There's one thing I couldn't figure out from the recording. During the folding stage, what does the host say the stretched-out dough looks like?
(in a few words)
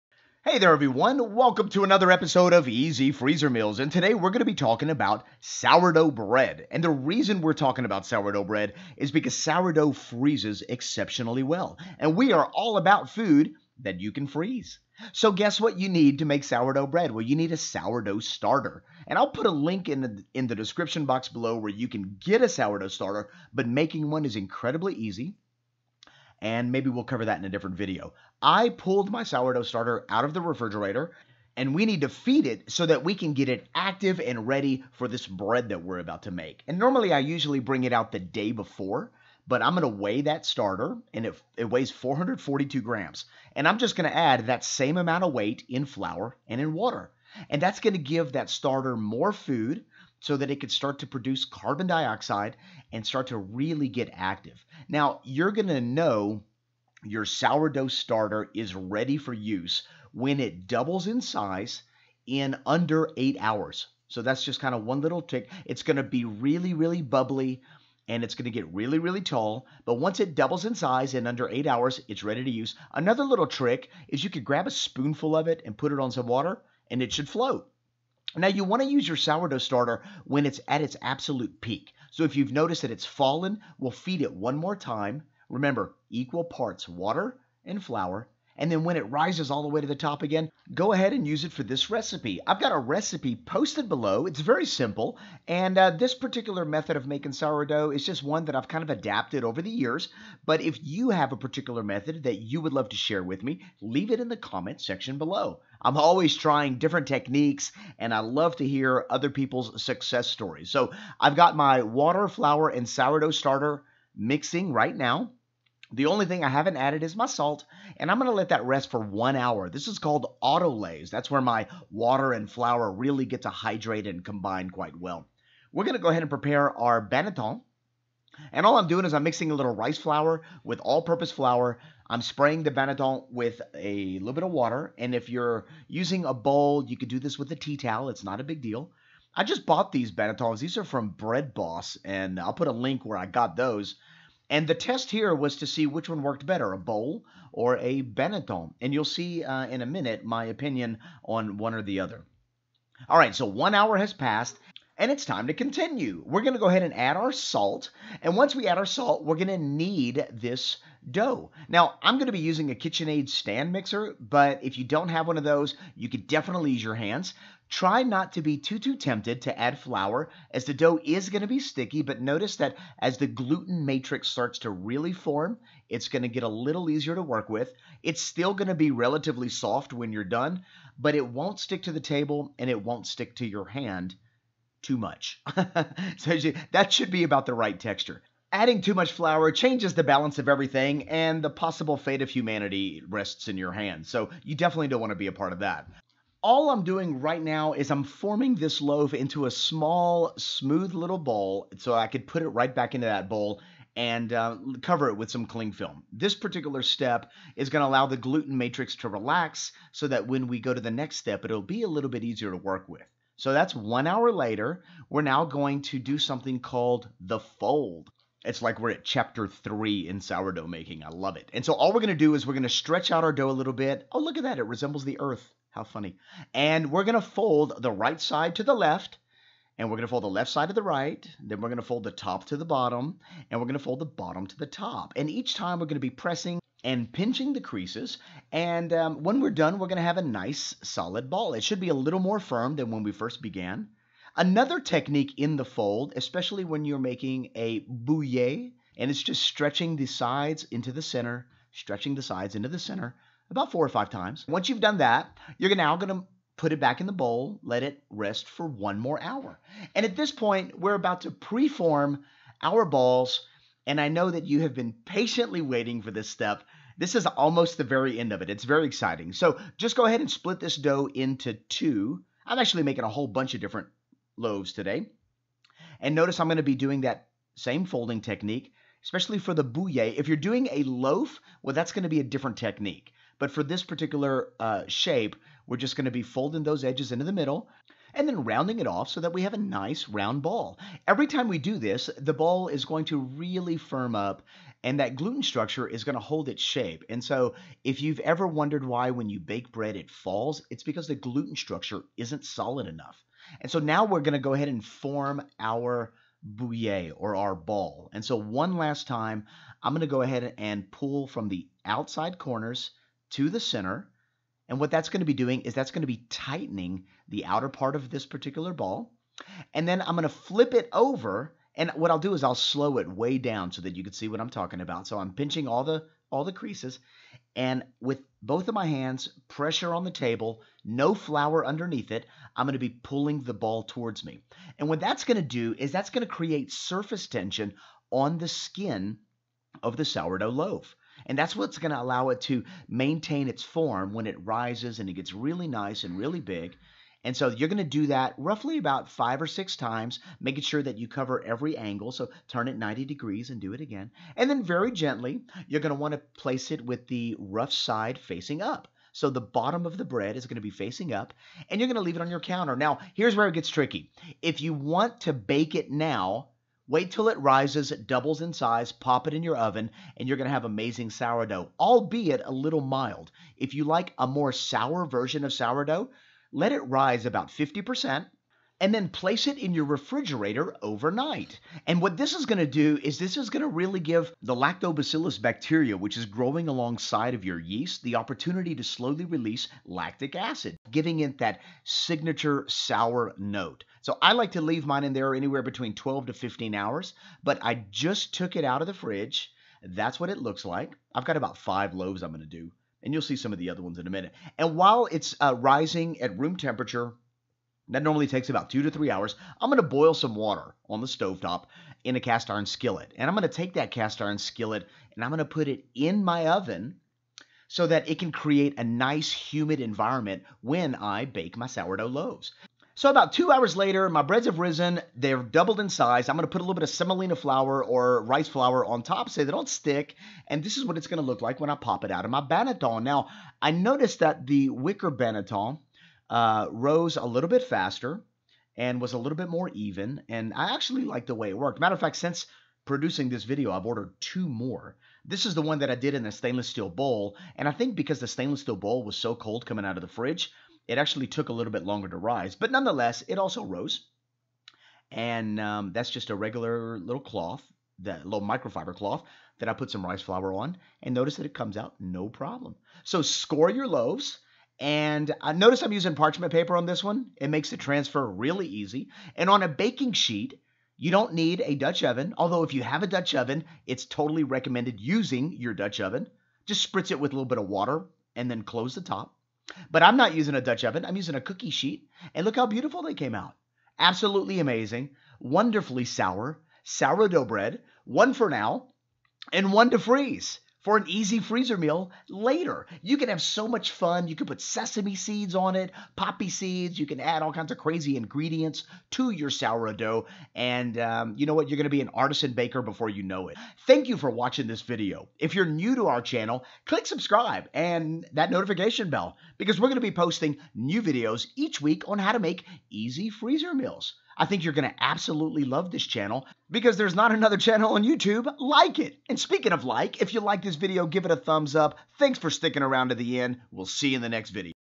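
the earth.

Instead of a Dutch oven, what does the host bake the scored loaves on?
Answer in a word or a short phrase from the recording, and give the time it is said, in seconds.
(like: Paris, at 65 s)
a cookie sheet, at 481 s.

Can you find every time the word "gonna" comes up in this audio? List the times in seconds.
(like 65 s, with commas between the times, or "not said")
118 s, 125 s.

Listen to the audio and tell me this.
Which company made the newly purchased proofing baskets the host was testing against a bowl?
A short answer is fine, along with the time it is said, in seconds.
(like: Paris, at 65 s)
Bread Boss, at 141 s.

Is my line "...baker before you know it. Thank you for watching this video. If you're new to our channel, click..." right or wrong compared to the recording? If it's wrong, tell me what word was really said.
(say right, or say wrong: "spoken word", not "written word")
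right.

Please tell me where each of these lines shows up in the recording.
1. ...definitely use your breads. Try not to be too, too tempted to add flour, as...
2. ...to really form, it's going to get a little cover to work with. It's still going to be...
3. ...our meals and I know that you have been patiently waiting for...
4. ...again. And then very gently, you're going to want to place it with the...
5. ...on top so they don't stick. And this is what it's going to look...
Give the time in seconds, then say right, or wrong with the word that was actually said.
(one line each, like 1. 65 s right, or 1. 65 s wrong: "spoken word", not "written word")
1. 166 s wrong: "hands", not "breads"
2. 174 s wrong: "easier", not "cover"
3. 262 s wrong: "balls", not "meals"
4. 353 s right
5. 428 s right.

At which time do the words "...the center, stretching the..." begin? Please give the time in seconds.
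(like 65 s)
250 s.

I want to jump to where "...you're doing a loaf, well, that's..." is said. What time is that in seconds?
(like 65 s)
280 s.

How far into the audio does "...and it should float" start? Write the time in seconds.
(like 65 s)
76 s.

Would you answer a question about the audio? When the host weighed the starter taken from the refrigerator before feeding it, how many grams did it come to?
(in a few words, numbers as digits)
442 grams.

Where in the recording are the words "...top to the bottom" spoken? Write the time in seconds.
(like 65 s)
232 s.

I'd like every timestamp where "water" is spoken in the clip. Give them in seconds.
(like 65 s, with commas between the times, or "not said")
46 s, 76 s, 86 s, 111 s, 121 s, 134 s, 410 s, 477 s.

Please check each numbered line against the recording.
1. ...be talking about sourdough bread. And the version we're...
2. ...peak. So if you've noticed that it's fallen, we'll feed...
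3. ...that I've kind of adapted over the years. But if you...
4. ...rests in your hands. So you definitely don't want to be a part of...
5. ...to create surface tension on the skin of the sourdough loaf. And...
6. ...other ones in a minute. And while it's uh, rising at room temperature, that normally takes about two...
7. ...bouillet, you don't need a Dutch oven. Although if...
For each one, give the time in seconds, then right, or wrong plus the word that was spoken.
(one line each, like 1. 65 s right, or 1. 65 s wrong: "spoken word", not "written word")
1. 4 s wrong: "reason", not "version"
2. 81 s right
3. 98 s right
4. 193 s right
5. 336 s right
6. 403 s right
7. 470 s wrong: "sheet", not "bouillet".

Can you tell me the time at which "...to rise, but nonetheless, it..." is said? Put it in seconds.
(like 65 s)
452 s.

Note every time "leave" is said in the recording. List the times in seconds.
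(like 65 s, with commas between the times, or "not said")
103 s, 362 s, 394 s.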